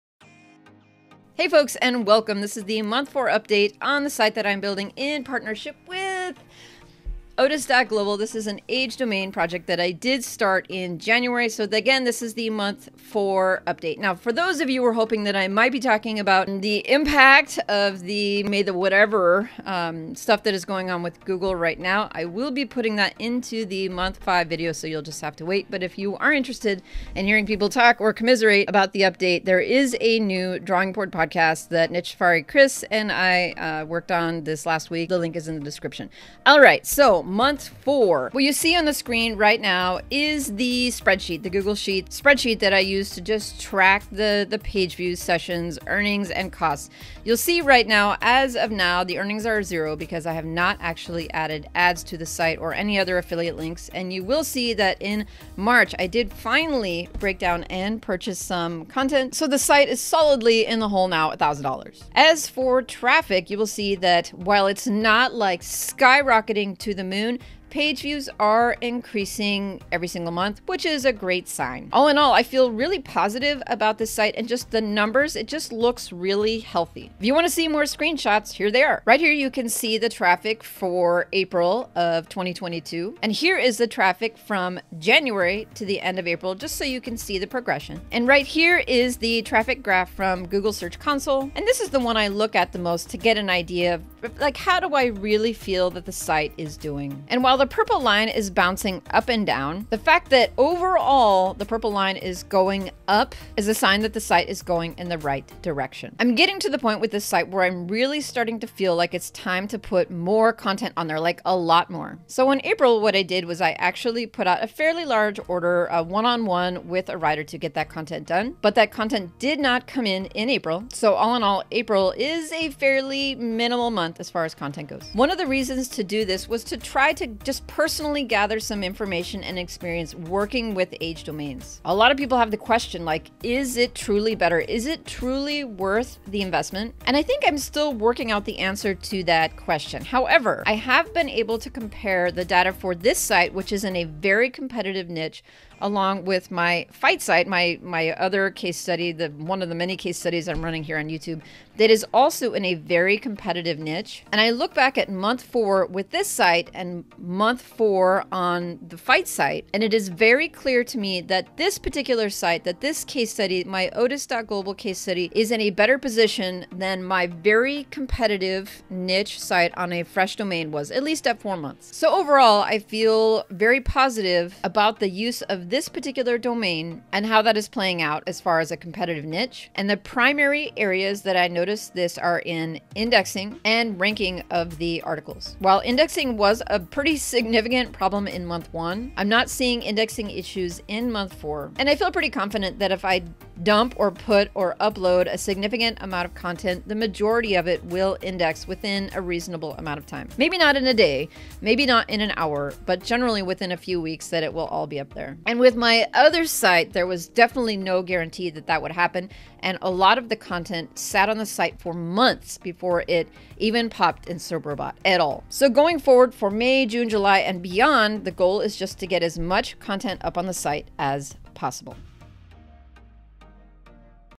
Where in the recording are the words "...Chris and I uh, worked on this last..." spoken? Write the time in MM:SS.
00:32.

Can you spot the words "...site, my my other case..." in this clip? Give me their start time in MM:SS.
02:27.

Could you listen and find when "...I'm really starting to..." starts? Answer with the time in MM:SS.
01:47.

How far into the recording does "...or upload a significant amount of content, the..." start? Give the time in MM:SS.
03:14.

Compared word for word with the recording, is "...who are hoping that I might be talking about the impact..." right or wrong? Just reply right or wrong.
right.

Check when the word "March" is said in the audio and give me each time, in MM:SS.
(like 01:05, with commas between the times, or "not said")
00:55.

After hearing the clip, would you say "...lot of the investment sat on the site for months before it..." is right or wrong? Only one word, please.
wrong.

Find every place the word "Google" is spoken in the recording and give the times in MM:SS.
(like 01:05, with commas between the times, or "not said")
00:21, 00:41, 01:30.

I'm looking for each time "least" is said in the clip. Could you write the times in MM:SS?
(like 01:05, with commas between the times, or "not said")
02:51.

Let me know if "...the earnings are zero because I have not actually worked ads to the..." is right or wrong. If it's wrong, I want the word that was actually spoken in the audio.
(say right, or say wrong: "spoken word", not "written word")
wrong: "added", not "worked".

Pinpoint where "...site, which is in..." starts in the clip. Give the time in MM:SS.
02:23.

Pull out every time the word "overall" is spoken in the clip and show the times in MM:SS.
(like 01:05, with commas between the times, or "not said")
01:40, 02:52.